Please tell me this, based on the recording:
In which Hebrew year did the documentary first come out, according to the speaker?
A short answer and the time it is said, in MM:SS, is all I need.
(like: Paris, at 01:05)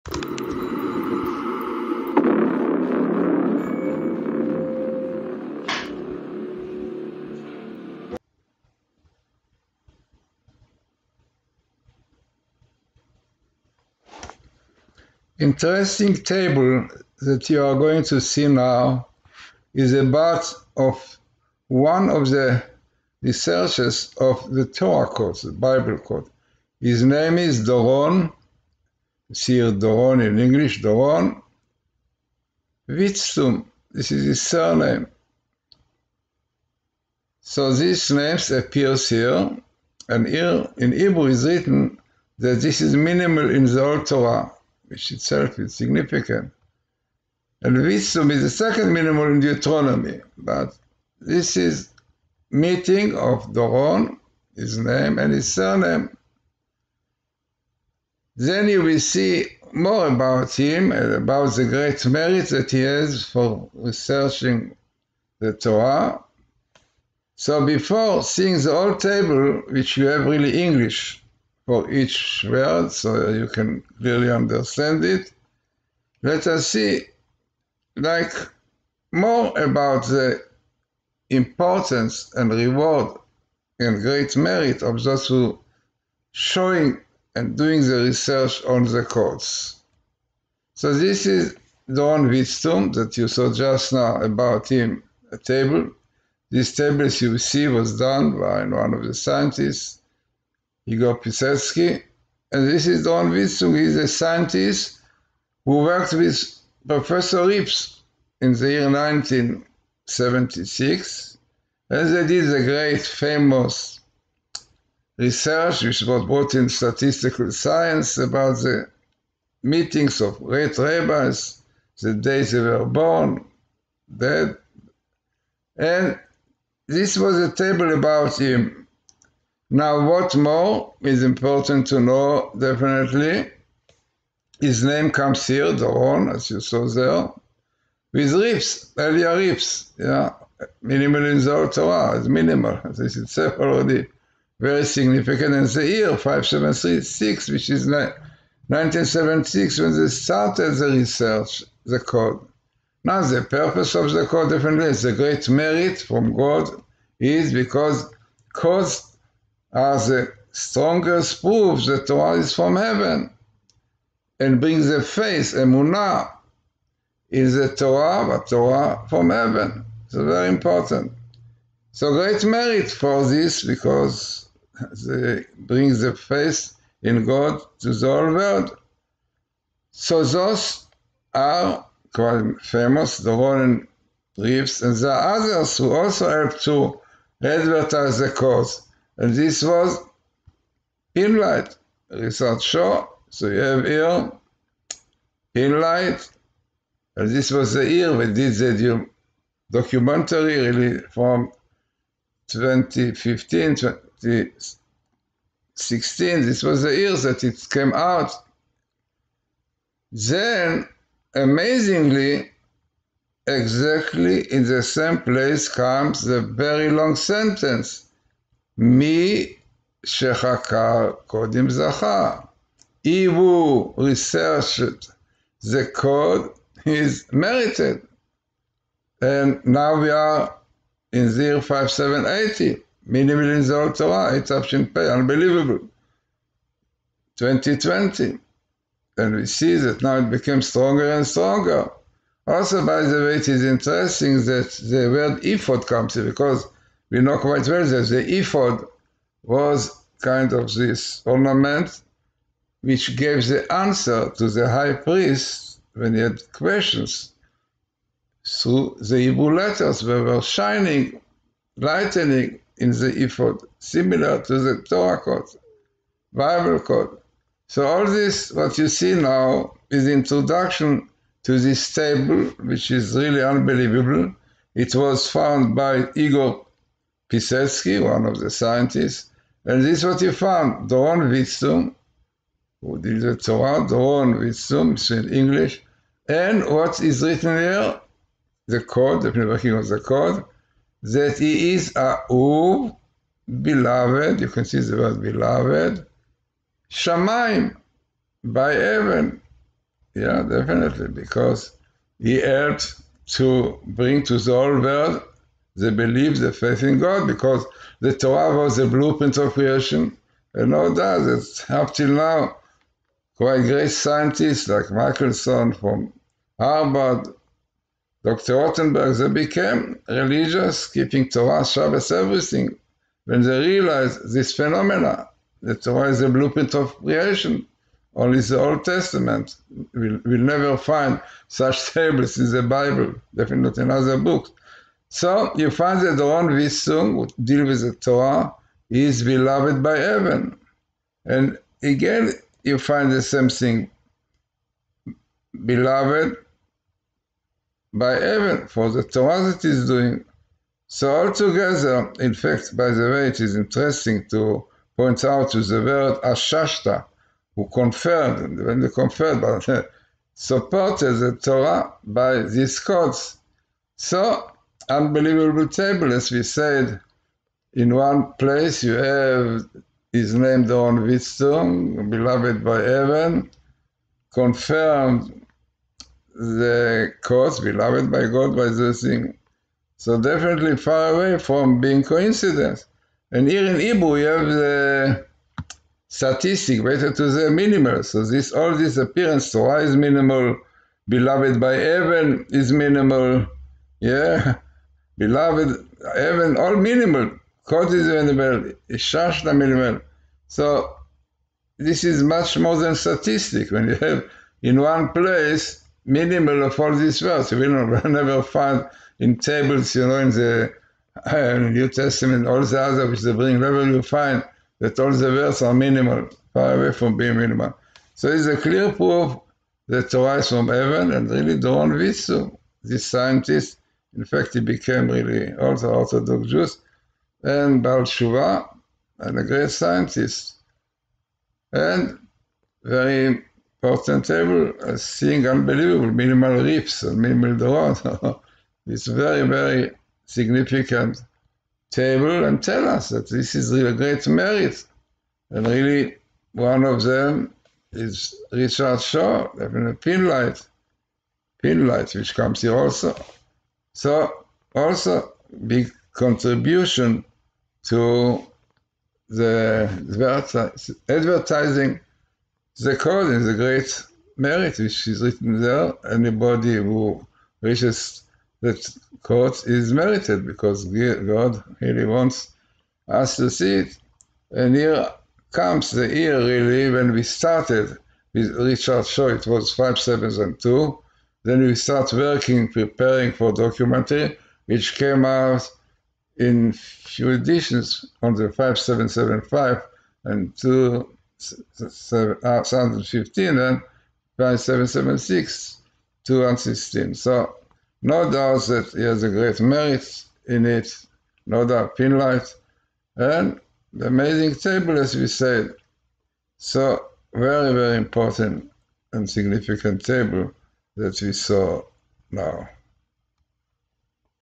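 5775, at 08:08.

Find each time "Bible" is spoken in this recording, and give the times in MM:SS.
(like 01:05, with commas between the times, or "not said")
00:25, 04:26, 05:32.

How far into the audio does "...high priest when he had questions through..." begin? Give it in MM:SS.
04:14.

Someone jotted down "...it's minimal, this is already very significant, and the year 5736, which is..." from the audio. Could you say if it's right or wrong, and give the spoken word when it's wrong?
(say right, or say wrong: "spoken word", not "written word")
right.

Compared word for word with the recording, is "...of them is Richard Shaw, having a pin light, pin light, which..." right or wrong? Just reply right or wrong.
right.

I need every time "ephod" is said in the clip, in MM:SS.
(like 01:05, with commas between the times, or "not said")
04:08, 04:23.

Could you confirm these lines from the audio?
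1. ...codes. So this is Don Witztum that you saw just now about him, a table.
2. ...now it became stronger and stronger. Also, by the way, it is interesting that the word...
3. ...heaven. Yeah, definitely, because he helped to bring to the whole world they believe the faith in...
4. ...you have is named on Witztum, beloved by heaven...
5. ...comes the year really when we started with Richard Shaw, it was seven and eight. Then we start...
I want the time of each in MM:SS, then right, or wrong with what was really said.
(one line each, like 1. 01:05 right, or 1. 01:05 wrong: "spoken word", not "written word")
1. 01:29 right
2. 04:00 right
3. 04:58 right
4. 06:08 right
5. 07:55 wrong: "two", not "eight".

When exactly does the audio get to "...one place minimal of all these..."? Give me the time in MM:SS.
06:44.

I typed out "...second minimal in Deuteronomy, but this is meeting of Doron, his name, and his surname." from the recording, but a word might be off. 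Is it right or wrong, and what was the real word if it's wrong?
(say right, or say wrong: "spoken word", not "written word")
right.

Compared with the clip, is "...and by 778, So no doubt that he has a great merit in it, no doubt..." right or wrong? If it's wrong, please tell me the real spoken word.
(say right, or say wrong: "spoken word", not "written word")
wrong: "776", not "778".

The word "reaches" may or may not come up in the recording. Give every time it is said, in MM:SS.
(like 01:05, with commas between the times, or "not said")
07:47.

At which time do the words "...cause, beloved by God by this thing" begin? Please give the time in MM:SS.
06:17.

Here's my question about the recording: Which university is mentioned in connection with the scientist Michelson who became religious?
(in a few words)
Harvard.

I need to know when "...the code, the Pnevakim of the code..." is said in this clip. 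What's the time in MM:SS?
04:48.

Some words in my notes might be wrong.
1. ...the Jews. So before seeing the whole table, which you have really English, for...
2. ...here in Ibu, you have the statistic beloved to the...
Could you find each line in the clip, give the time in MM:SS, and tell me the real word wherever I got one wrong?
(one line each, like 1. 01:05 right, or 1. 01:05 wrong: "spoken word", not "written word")
1. 01:05 wrong: "Torah", not "Jews"
2. 06:23 wrong: "related", not "beloved".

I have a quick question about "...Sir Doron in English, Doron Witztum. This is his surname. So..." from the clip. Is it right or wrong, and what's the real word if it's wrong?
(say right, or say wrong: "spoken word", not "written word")
right.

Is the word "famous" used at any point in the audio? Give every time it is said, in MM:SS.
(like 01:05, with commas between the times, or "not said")
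01:53, 03:02.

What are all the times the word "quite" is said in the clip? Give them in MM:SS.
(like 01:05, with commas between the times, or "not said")
03:02, 04:07, 05:13.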